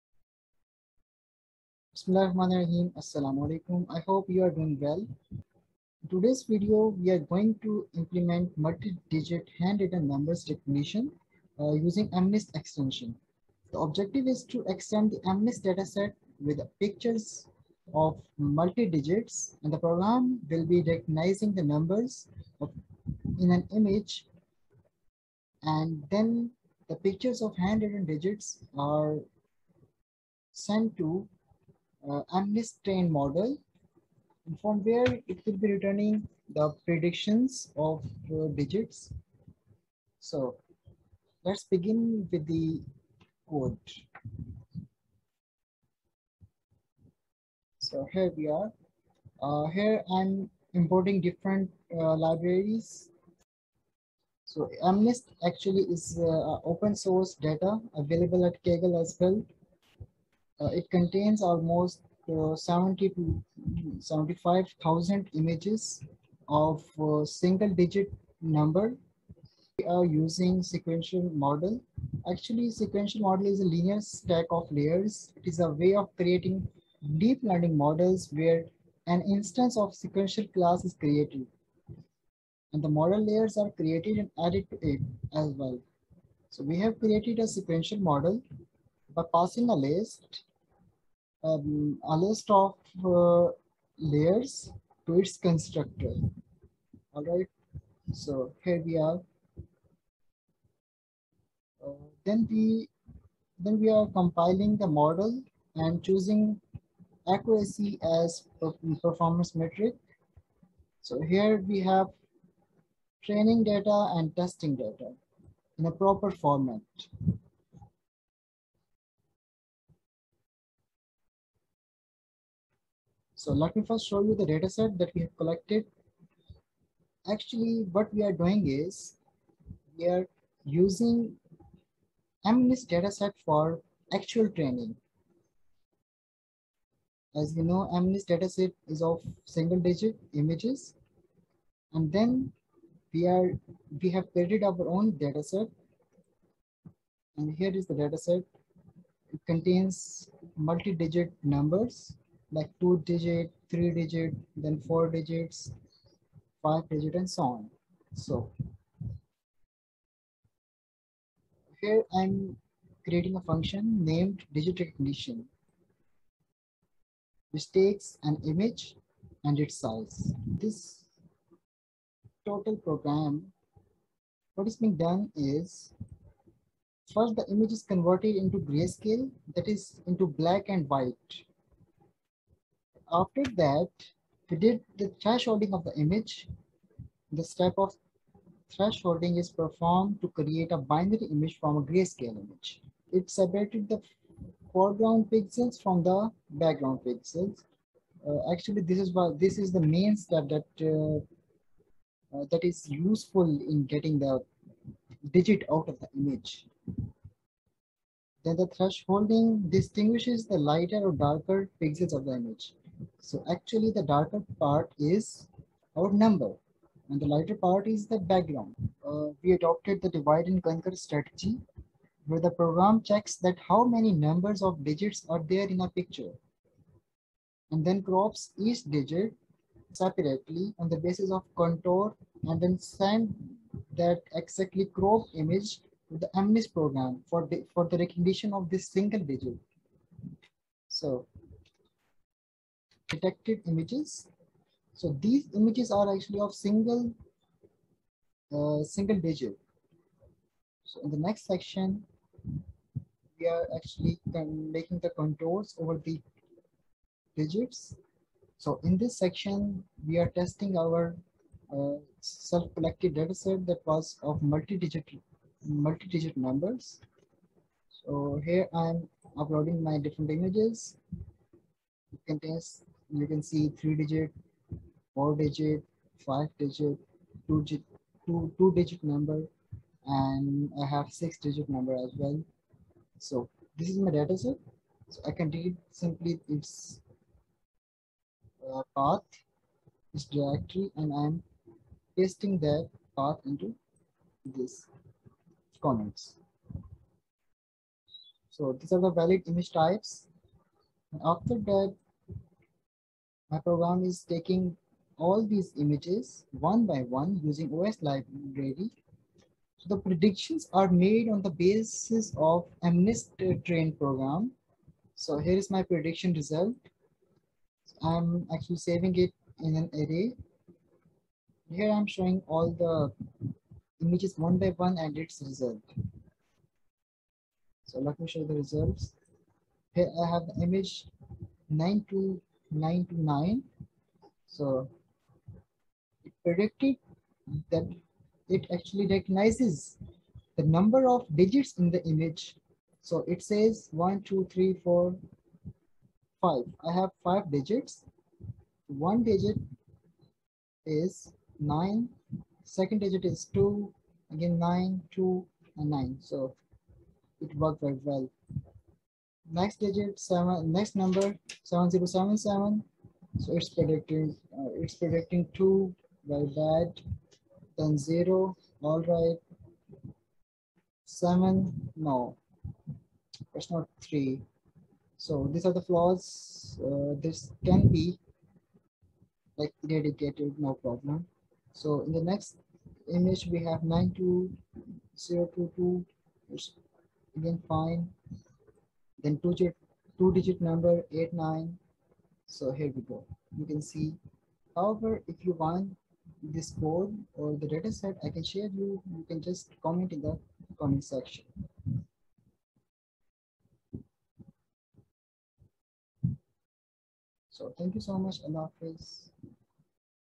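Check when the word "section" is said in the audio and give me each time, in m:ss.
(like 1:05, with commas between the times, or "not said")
4:11, 4:19, 6:41.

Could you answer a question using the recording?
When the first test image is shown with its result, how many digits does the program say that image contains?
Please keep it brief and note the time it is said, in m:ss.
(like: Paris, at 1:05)
5, at 5:47.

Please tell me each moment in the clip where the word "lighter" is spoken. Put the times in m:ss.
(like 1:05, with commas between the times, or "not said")
3:30, 3:37.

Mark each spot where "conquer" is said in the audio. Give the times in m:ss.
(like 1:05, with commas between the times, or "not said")
3:40.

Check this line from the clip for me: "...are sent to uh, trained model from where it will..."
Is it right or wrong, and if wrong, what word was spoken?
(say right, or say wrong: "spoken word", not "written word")
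right.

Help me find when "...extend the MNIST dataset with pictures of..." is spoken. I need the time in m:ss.
0:14.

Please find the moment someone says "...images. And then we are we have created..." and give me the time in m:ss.
2:20.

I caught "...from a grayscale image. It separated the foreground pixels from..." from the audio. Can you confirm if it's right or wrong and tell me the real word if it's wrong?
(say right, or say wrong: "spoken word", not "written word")
right.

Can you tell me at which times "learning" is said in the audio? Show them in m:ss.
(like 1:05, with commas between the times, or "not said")
1:17.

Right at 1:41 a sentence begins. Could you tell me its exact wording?
Uh, then we then we are compiling the model and choosing accuracy as performance metric.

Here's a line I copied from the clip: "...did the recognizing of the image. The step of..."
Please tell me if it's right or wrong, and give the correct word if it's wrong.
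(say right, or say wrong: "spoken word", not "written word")
wrong: "thresholding", not "recognizing".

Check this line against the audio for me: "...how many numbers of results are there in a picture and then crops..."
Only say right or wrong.
wrong.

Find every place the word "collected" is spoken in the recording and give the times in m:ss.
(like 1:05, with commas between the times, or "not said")
2:05, 4:22.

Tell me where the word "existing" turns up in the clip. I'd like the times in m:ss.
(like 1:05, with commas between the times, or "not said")
not said.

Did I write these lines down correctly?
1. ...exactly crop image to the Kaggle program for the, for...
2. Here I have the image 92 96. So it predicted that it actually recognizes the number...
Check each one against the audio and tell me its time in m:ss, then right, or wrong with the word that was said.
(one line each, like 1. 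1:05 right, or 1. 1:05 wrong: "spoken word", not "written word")
1. 3:54 wrong: "MNIST", not "Kaggle"
2. 5:29 wrong: "99", not "96".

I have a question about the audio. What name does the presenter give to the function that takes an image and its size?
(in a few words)
digit recognition.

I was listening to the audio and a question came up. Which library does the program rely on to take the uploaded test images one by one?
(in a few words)
OS.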